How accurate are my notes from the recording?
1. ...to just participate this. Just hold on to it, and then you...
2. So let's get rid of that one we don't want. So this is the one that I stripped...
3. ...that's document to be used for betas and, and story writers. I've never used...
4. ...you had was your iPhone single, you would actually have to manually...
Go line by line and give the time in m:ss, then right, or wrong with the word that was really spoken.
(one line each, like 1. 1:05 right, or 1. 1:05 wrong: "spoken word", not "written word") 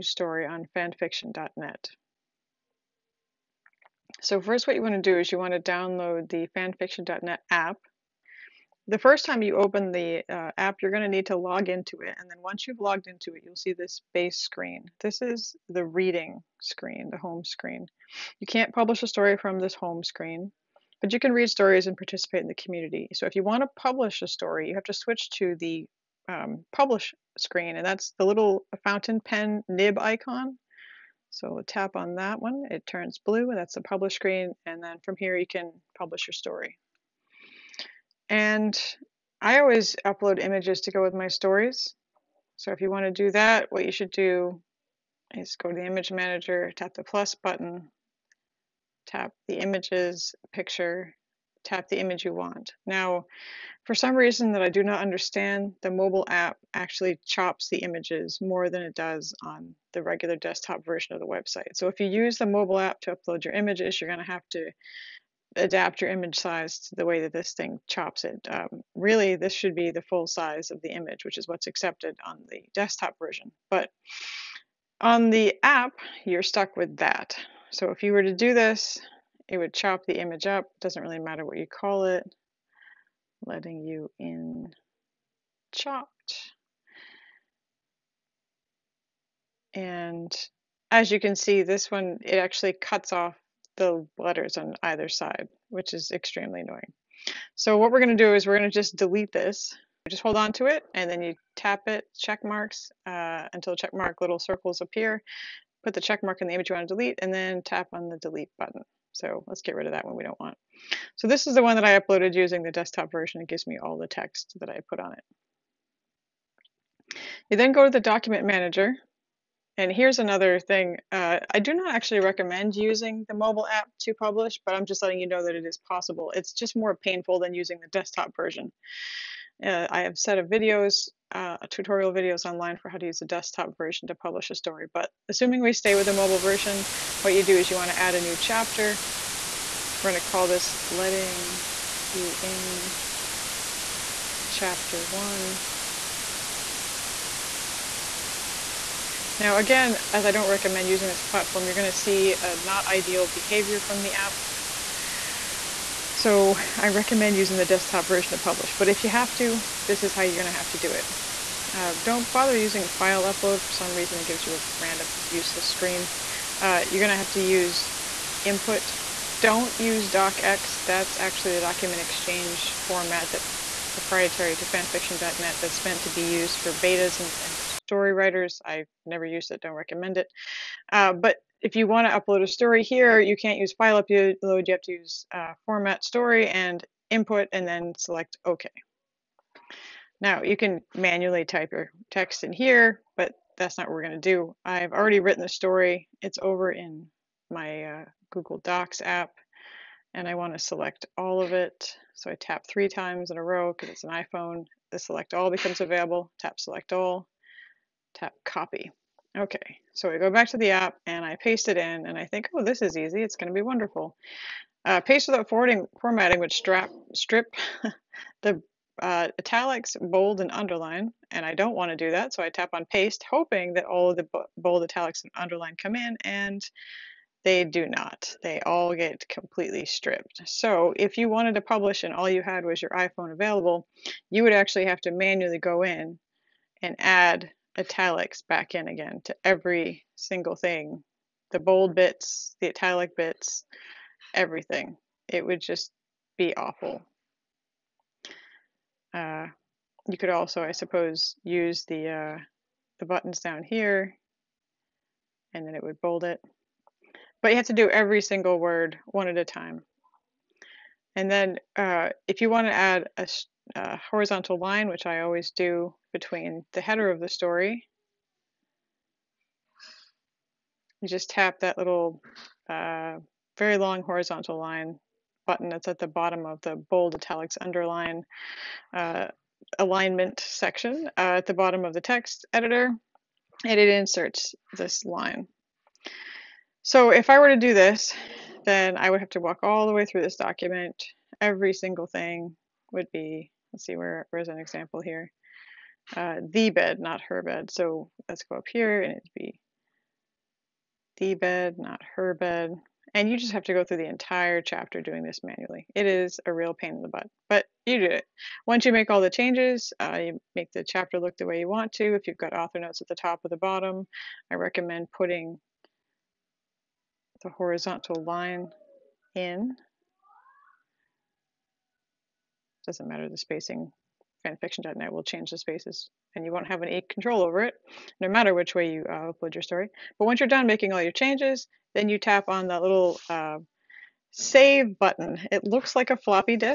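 1. 1:38 wrong: "delete", not "participate"
2. 1:49 wrong: "uploaded", not "stripped"
3. 2:55 wrong: "meant", not "document"
4. 3:52 wrong: "available", not "single".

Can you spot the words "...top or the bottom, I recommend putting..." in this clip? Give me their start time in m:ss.
5:13.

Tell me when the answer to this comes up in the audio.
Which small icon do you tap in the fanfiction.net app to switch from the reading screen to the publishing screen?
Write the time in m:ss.
0:28.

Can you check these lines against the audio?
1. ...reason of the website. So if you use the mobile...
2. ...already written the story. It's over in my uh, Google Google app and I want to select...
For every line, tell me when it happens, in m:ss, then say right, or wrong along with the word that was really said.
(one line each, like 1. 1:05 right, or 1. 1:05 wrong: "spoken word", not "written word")
1. 1:00 wrong: "version", not "reason"
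2. 3:14 wrong: "Docs", not "Google".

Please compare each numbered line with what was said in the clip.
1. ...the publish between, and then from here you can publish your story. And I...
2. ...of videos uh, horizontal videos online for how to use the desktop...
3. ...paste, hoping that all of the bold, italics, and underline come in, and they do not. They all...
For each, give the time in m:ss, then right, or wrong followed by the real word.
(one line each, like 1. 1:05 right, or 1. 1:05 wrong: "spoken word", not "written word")
1. 0:33 wrong: "screen", not "between"
2. 2:10 wrong: "tutorial", not "horizontal"
3. 3:42 right.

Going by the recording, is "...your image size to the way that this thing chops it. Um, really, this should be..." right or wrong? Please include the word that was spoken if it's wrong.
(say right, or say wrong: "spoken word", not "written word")
right.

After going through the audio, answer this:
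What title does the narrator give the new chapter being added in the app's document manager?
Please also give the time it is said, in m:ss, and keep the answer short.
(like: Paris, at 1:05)
Letting You In Chapter One, at 2:20.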